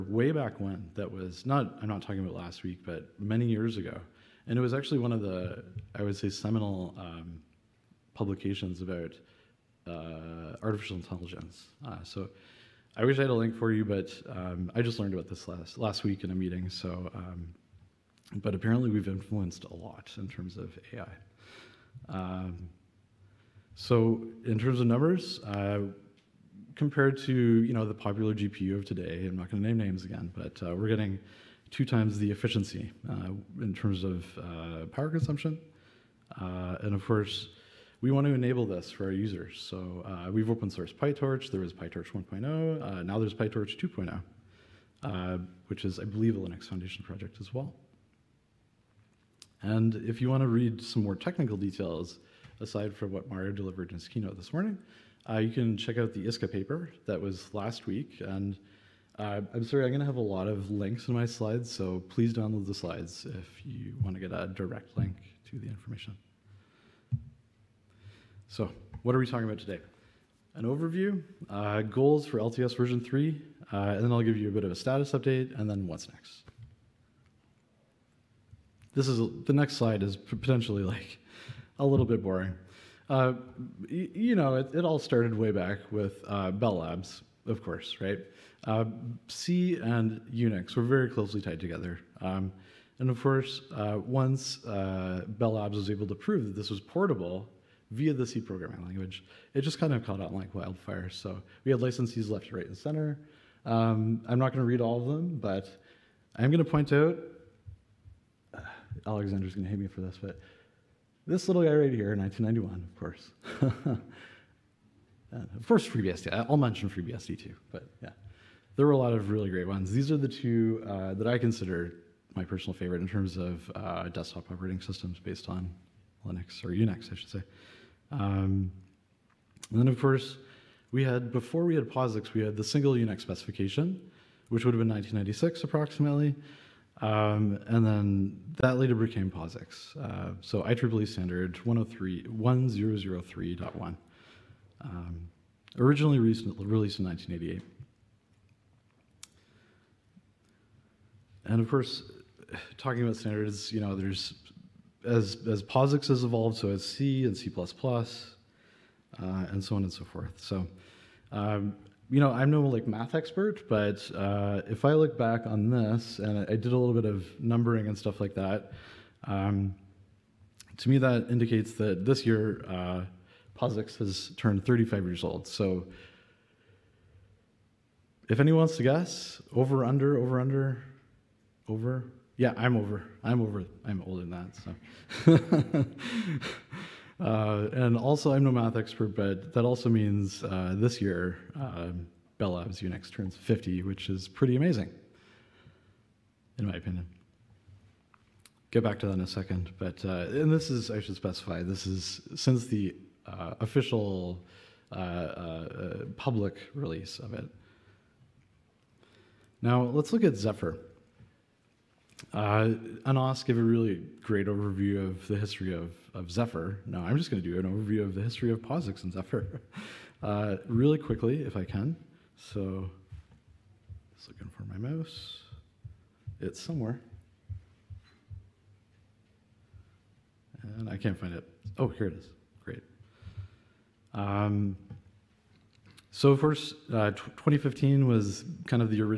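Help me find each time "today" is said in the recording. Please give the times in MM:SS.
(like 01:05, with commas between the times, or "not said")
00:28, 01:09.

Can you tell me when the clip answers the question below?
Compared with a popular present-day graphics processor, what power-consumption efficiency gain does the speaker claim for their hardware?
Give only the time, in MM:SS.
00:31.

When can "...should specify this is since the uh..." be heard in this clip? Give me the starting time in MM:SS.
03:21.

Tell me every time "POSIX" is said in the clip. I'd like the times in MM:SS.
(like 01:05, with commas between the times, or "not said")
02:11, 02:19, 02:35, 02:53, 03:38.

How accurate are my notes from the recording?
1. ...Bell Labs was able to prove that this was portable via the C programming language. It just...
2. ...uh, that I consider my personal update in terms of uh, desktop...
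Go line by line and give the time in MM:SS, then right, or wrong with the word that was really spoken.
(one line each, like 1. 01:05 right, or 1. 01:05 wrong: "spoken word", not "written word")
1. 01:34 right
2. 02:00 wrong: "favorite", not "update".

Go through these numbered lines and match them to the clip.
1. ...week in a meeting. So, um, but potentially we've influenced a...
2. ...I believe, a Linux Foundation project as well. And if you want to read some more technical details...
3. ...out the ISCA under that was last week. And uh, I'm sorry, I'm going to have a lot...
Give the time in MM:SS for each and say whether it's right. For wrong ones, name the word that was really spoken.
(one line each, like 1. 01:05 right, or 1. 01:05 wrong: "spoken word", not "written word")
1. 00:16 wrong: "apparently", not "potentially"
2. 00:45 right
3. 00:55 wrong: "paper", not "under".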